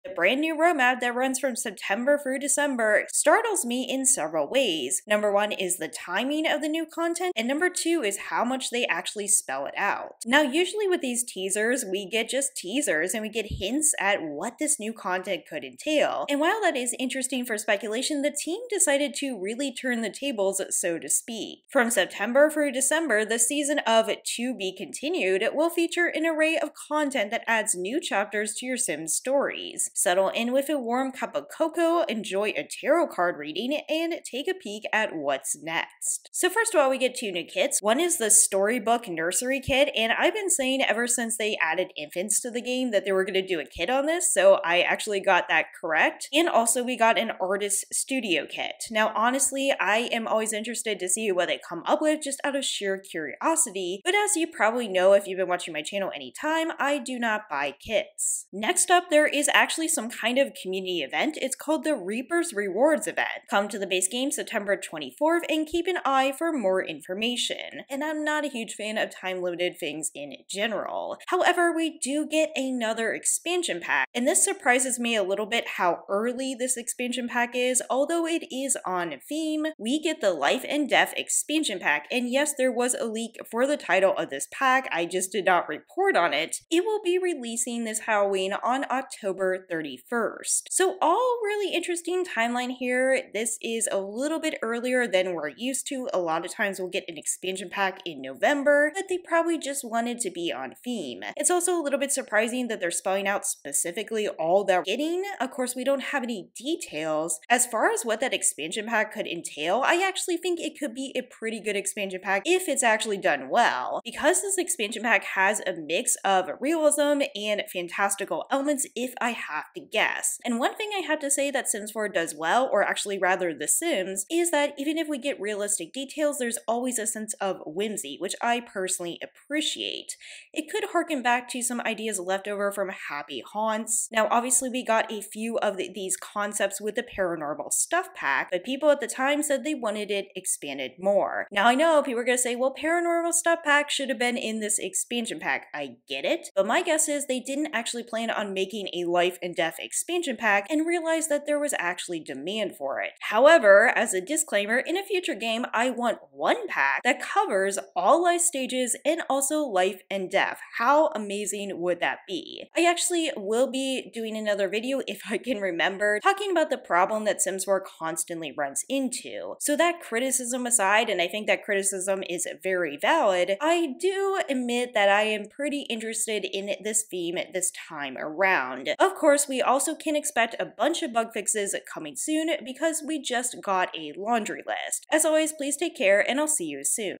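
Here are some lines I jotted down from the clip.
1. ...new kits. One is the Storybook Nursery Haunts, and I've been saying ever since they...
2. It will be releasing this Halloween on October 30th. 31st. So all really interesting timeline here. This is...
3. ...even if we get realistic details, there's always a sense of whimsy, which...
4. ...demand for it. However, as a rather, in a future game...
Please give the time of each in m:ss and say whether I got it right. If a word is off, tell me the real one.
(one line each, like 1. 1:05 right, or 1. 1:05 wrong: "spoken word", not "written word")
1. 0:37 wrong: "Kit", not "Haunts"
2. 1:26 right
3. 2:04 right
4. 2:32 wrong: "disclaimer", not "rather".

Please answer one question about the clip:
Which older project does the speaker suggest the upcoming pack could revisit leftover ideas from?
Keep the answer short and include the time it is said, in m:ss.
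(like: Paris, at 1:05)
Happy Haunts, at 2:13.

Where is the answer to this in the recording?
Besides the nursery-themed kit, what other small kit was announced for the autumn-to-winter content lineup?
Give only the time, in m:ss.
0:47.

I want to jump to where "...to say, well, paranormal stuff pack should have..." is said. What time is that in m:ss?
2:22.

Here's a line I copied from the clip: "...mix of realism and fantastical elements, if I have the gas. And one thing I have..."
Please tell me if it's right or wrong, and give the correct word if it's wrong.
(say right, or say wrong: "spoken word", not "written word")
right.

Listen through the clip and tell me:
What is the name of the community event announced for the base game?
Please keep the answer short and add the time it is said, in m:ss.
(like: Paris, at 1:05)
Reaper's Rewards, at 1:01.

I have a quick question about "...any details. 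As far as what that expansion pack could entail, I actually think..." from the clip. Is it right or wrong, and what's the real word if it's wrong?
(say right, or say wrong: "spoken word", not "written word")
right.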